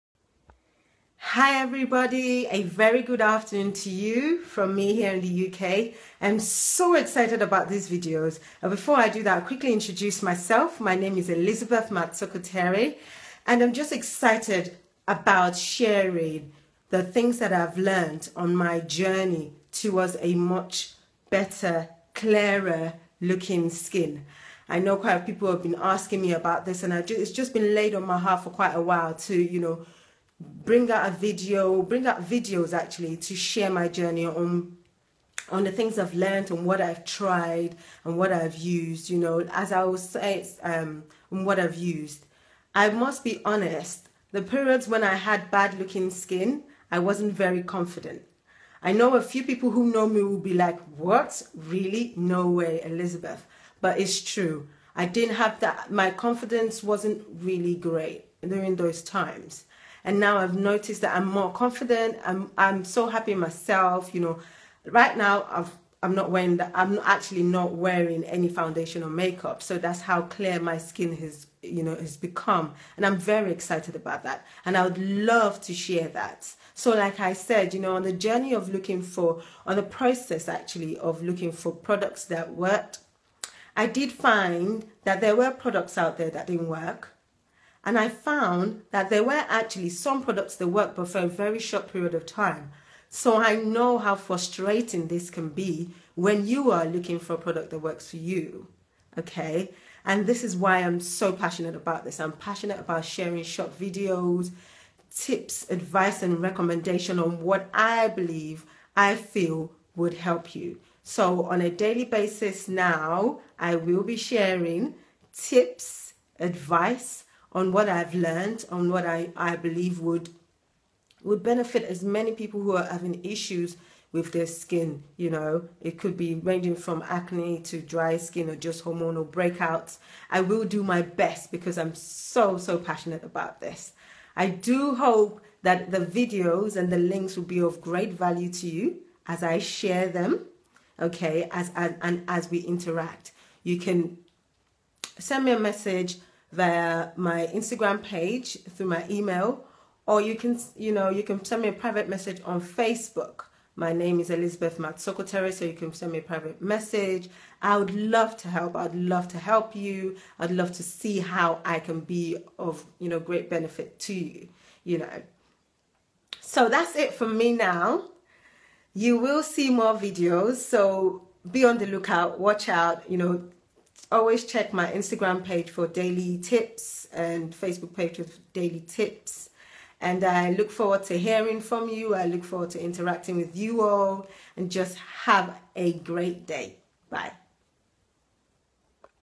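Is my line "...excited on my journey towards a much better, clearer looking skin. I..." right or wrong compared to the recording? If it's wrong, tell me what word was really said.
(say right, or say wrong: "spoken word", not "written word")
wrong: "learned", not "excited".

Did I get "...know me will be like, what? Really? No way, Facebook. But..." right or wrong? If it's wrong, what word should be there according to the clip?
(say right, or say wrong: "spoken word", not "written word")
wrong: "Elizabeth", not "Facebook".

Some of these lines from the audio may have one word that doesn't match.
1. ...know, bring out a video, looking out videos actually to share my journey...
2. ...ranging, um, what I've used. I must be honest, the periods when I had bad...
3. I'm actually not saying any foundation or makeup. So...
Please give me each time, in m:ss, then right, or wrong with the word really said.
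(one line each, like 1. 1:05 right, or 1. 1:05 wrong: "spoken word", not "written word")
1. 0:29 wrong: "bring", not "looking"
2. 0:40 wrong: "saying", not "ranging"
3. 1:06 wrong: "wearing", not "saying".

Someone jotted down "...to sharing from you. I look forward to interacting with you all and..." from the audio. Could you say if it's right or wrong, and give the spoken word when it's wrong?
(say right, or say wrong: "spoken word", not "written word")
wrong: "hearing", not "sharing".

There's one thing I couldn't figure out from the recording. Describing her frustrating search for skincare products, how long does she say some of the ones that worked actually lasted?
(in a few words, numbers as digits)
very short period.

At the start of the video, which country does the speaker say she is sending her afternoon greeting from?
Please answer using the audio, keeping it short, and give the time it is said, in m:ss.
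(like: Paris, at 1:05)
UK, at 0:05.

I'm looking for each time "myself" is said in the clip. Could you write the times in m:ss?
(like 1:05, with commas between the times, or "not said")
0:10, 1:03.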